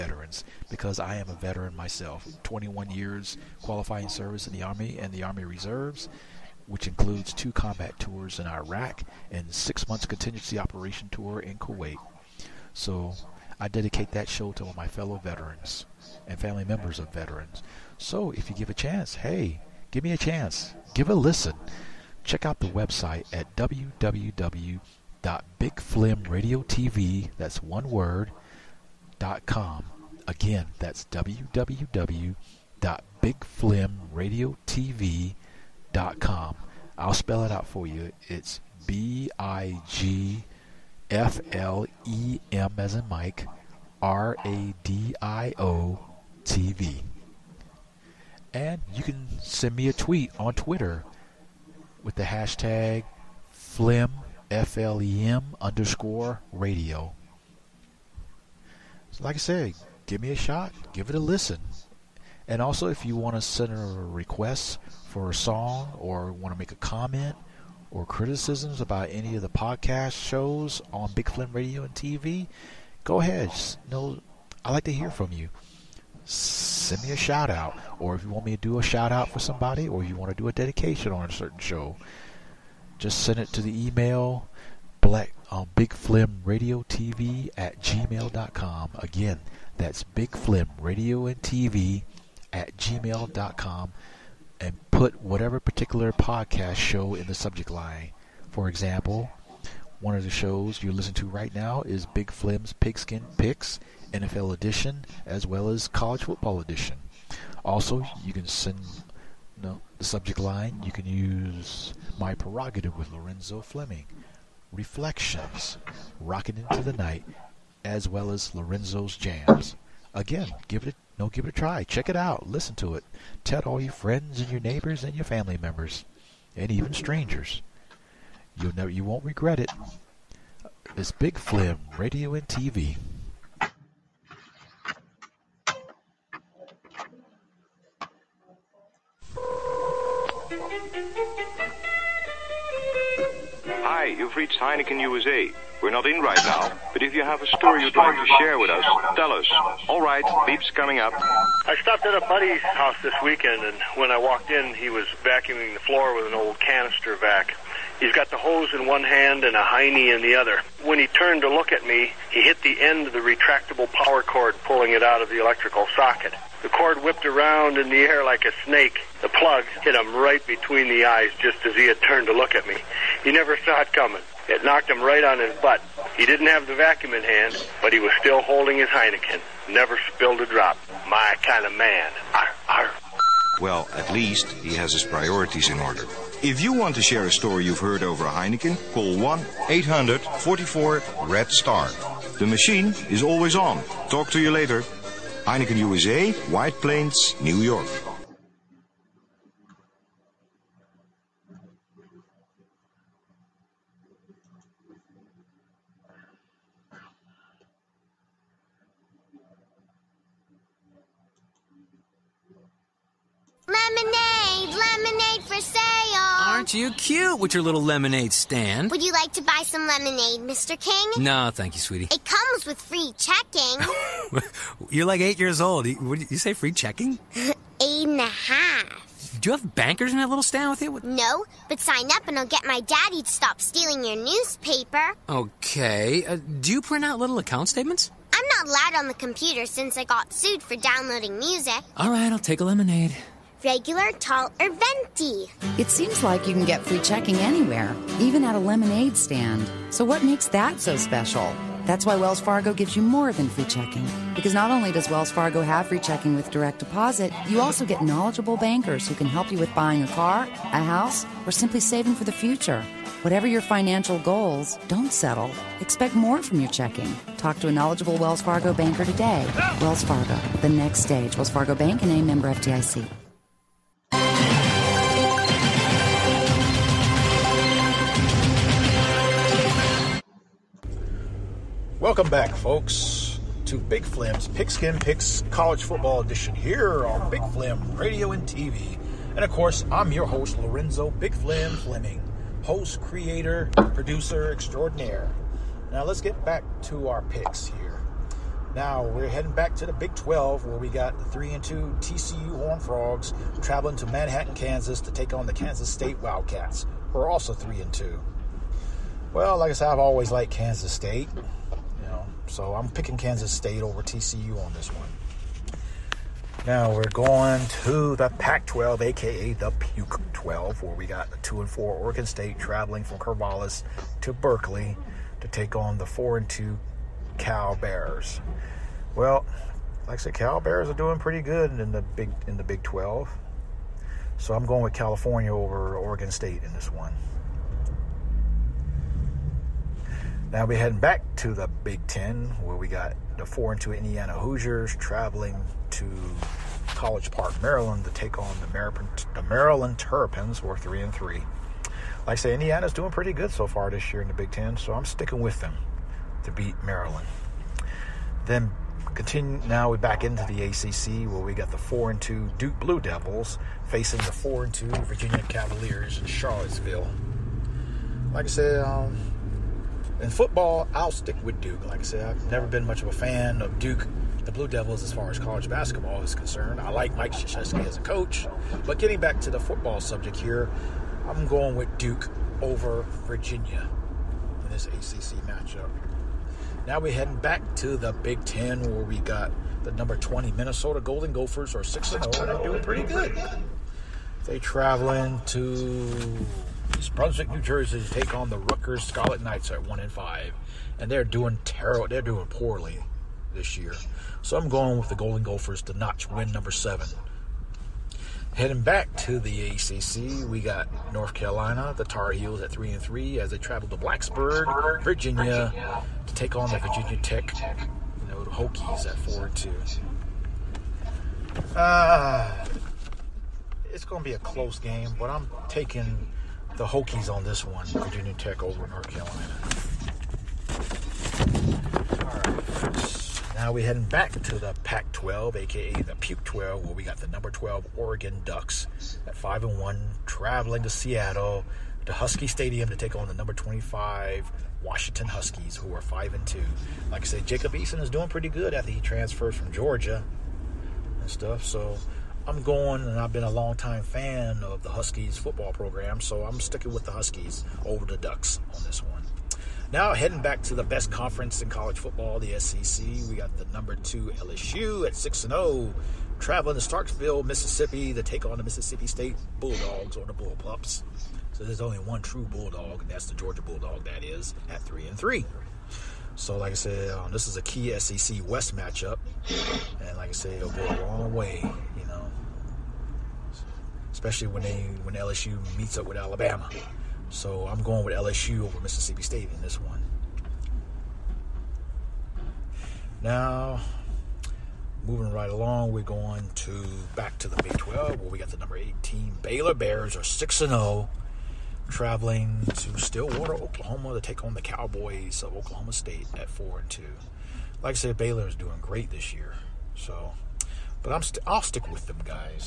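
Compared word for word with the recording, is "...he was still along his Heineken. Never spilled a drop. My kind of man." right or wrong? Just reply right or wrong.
wrong.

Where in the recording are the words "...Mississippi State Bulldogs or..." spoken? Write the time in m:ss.
7:48.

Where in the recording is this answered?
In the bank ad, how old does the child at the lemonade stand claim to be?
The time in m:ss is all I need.
3:47.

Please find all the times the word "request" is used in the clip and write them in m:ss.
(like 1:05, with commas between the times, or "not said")
1:03.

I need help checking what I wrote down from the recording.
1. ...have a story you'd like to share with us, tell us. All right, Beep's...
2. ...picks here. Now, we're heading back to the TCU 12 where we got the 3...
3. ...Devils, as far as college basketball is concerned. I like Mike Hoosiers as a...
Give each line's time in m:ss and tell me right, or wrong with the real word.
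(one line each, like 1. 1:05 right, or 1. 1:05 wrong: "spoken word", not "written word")
1. 2:27 right
2. 4:57 wrong: "Big", not "TCU"
3. 6:14 wrong: "Krzyzewski", not "Hoosiers".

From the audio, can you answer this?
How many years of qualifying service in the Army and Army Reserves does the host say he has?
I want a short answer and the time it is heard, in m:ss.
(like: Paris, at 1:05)
21, at 0:02.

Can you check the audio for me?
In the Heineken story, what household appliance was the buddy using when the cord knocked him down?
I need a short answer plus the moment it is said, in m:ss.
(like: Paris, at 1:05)
canister vac, at 2:36.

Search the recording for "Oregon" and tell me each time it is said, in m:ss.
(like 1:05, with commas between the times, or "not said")
5:21, 5:35, 7:17.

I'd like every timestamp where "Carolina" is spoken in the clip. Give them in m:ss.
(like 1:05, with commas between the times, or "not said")
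6:51, 7:09.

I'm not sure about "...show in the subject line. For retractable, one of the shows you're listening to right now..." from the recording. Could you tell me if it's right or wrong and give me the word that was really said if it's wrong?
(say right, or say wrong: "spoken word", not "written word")
wrong: "example", not "retractable".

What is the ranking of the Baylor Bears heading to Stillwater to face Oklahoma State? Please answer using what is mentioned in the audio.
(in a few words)
18.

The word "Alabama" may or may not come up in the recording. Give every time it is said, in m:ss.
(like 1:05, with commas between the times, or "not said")
8:06.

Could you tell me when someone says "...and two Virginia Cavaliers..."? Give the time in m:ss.
6:04.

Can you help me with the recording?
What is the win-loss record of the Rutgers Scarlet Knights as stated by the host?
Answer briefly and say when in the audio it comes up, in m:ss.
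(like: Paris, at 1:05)
1 and 5, at 6:39.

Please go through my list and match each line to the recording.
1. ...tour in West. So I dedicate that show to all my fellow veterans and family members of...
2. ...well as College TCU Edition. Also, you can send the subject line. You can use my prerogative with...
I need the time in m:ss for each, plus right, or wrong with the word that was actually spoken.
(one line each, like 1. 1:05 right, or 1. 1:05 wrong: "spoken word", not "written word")
1. 0:11 wrong: "Kuwait", not "West"
2. 1:45 wrong: "Football", not "TCU".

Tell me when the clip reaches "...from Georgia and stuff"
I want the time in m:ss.
7:29.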